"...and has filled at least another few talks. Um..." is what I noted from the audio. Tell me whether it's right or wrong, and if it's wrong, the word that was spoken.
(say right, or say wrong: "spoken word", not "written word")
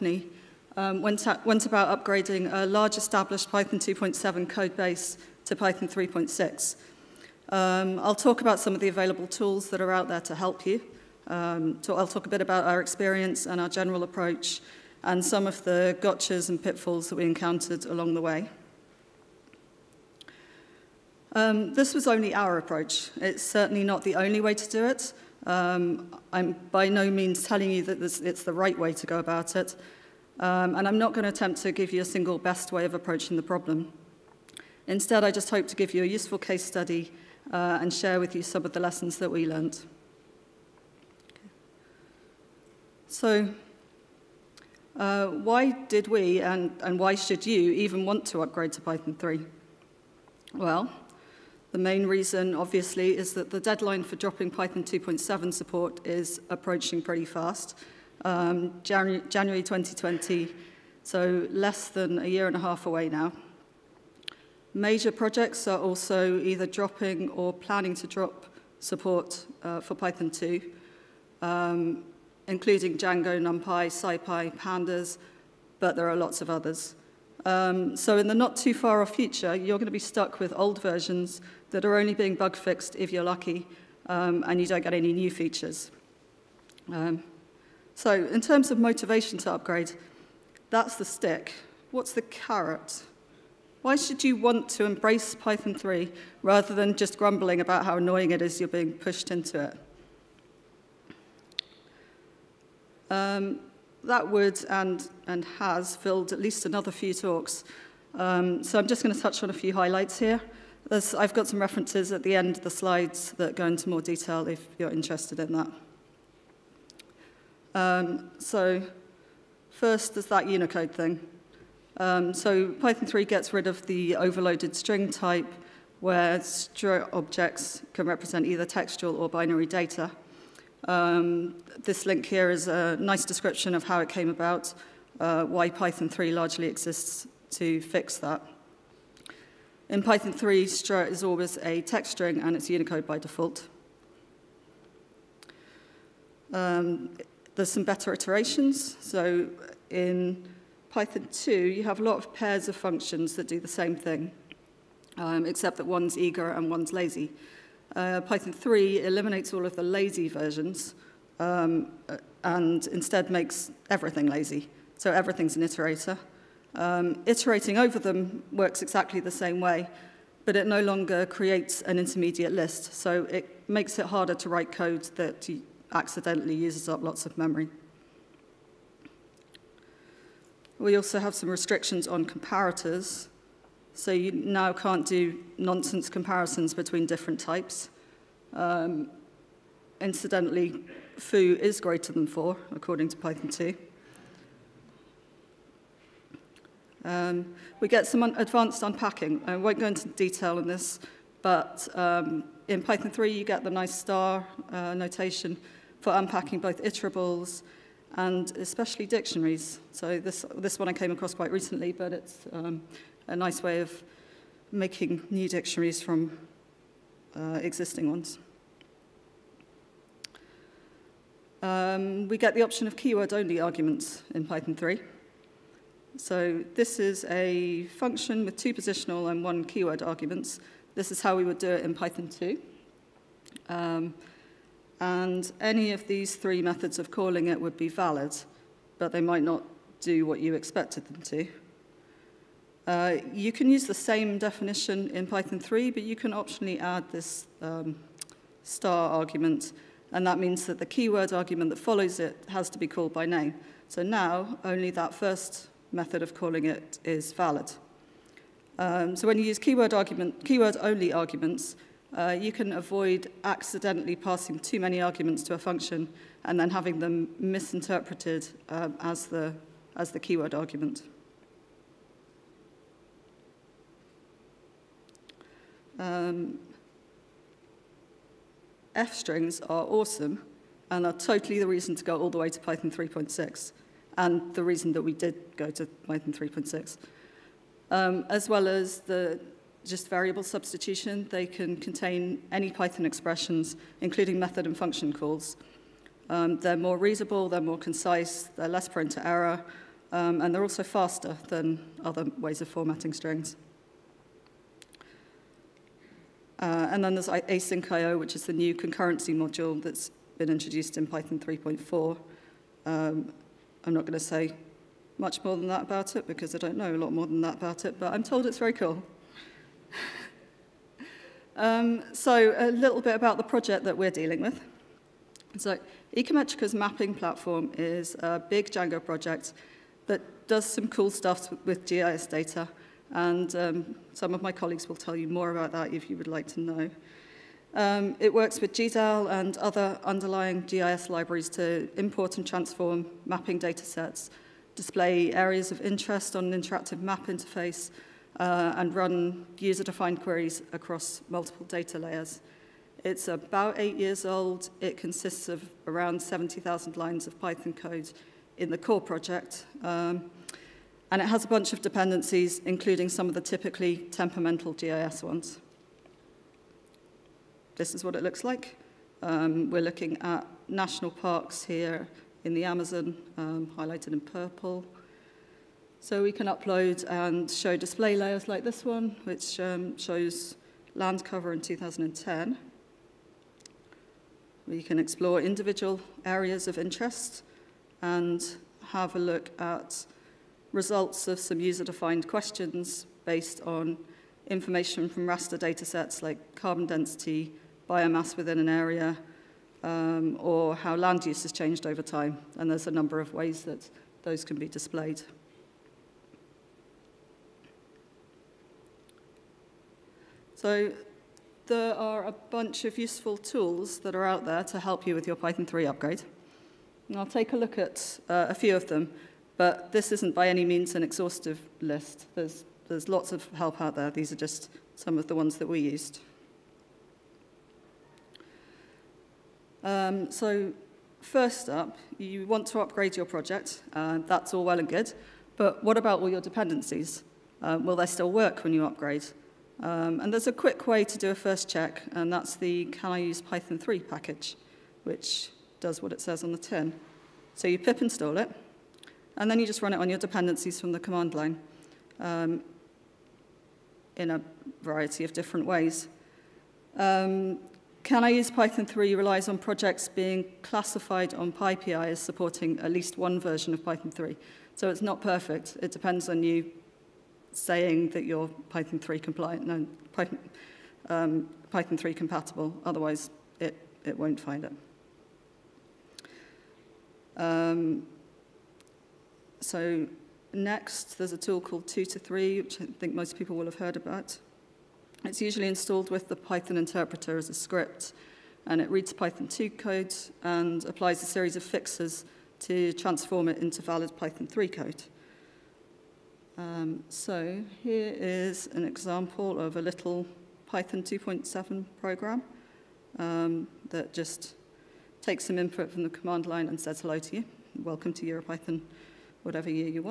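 right.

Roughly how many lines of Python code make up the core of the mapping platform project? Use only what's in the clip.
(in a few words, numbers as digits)
70,000.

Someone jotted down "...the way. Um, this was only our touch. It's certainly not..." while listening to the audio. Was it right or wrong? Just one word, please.
wrong.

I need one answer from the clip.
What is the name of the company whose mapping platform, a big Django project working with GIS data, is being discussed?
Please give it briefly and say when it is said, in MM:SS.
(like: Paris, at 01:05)
Ecometrica, at 05:26.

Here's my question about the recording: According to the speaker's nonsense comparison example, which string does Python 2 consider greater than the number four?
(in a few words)
foo.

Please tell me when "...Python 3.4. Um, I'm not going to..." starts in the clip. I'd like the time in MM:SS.
05:11.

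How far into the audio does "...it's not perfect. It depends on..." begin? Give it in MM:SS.
07:44.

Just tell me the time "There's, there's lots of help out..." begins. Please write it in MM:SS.
07:02.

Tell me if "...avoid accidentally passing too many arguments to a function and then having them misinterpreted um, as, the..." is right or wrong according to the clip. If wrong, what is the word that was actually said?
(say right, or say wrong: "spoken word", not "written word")
right.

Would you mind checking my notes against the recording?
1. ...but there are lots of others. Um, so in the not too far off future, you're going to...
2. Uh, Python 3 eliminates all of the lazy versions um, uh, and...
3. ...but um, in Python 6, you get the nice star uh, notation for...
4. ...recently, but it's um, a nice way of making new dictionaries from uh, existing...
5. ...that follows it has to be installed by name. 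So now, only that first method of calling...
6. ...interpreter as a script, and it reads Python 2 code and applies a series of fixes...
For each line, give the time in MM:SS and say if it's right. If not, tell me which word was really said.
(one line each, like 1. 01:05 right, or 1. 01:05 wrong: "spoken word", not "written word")
1. 01:15 right
2. 02:37 right
3. 03:21 wrong: "3", not "6"
4. 03:31 right
5. 04:11 wrong: "called", not "installed"
6. 08:06 right.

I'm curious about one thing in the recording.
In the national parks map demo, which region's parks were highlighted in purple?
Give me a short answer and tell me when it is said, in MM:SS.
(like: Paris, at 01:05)
the Amazon, at 06:12.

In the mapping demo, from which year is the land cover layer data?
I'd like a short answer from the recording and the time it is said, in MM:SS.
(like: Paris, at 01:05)
2010, at 06:21.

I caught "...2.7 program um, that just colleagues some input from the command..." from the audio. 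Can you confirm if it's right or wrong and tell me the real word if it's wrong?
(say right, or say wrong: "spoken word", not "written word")
wrong: "takes", not "colleagues".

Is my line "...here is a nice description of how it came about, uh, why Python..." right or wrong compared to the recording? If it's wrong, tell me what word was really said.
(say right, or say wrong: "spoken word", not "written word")
right.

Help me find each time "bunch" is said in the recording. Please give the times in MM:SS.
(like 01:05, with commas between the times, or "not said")
06:01, 06:52.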